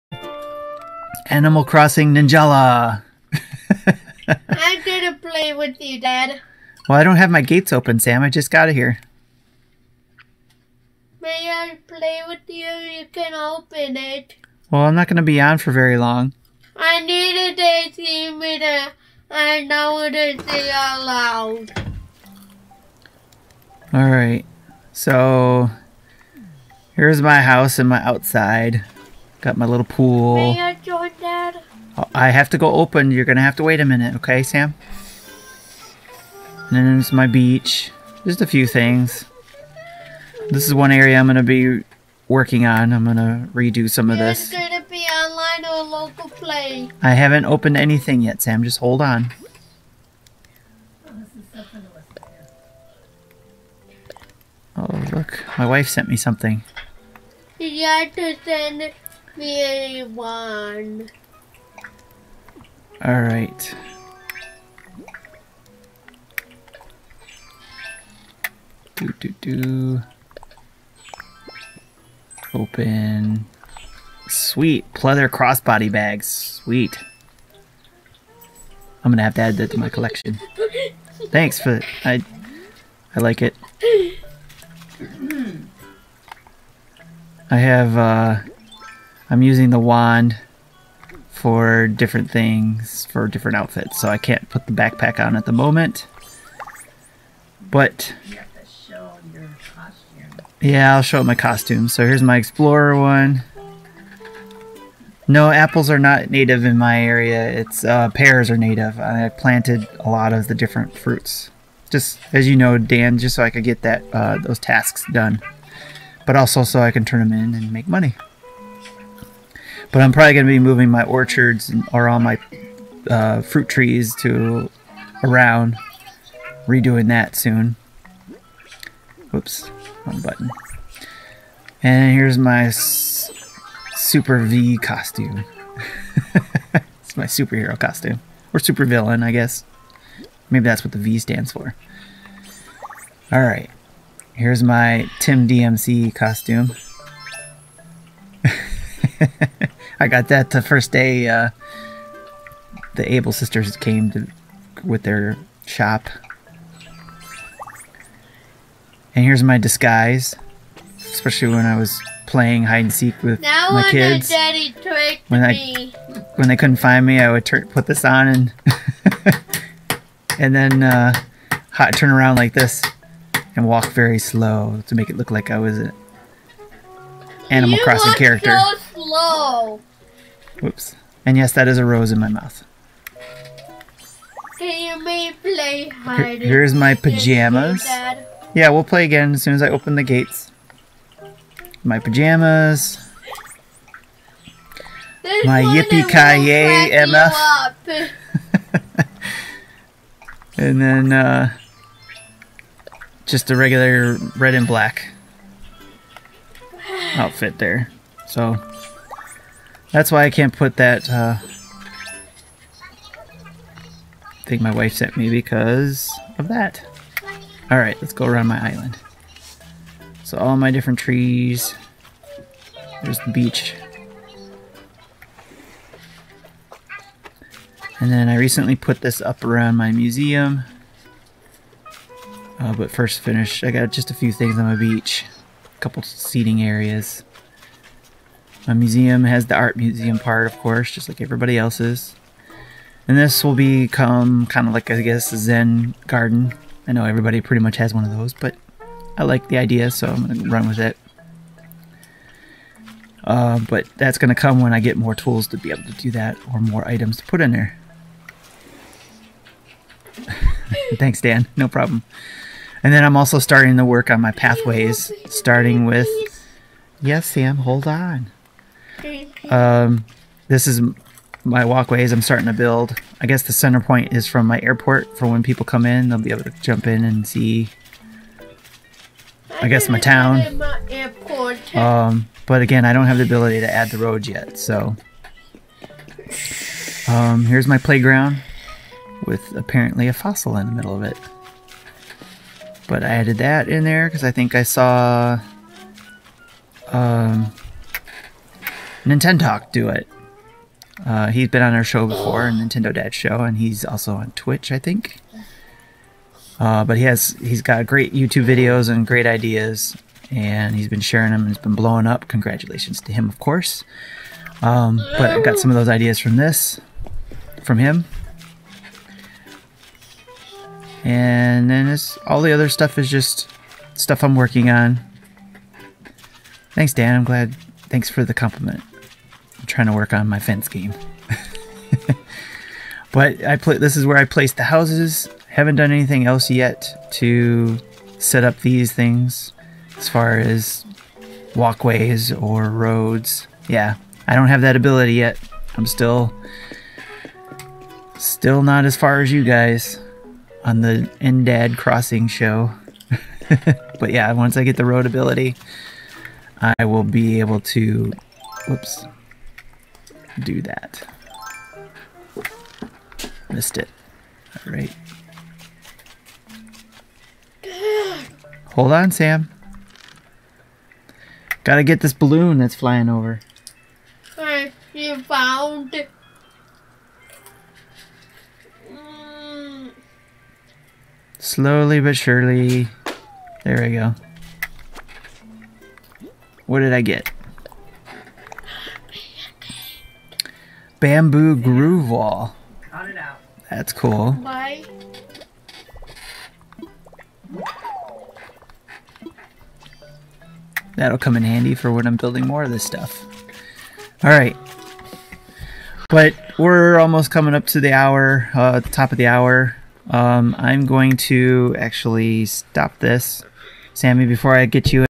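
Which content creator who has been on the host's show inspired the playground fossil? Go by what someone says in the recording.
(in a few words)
Nintendoc.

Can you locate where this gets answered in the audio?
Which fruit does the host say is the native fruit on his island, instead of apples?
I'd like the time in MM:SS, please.
01:48.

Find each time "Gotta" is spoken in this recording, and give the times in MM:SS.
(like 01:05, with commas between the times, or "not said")
06:11.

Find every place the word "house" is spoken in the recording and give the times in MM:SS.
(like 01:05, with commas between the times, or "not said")
00:27, 05:34.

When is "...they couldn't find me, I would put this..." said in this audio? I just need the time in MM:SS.
02:46.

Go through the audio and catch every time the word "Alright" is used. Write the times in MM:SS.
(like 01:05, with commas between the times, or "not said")
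02:23, 03:37, 06:44.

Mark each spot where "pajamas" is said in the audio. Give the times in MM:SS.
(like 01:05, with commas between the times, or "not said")
03:06, 03:11.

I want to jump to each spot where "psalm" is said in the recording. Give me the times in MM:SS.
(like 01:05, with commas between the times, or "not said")
not said.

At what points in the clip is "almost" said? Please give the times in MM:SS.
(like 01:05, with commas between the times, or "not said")
06:46.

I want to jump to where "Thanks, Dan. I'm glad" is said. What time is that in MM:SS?
05:26.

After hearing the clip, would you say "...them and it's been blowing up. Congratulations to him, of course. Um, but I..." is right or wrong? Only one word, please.
right.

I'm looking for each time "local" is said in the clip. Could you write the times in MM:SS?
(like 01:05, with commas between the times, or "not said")
00:45.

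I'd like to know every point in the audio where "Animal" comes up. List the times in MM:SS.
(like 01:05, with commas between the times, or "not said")
00:01, 02:57.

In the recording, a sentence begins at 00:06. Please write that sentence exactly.
Well, I don't have my gates open, Sam.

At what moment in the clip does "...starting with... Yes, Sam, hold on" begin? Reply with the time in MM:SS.
04:25.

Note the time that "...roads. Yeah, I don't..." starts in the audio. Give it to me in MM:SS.
05:42.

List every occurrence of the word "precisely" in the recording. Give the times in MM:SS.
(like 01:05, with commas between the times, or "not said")
not said.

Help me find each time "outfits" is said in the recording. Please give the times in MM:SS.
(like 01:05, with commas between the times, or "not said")
01:33, 03:27.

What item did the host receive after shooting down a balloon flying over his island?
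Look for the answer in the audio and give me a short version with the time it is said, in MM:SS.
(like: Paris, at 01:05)
Bamboo grove wall, at 06:31.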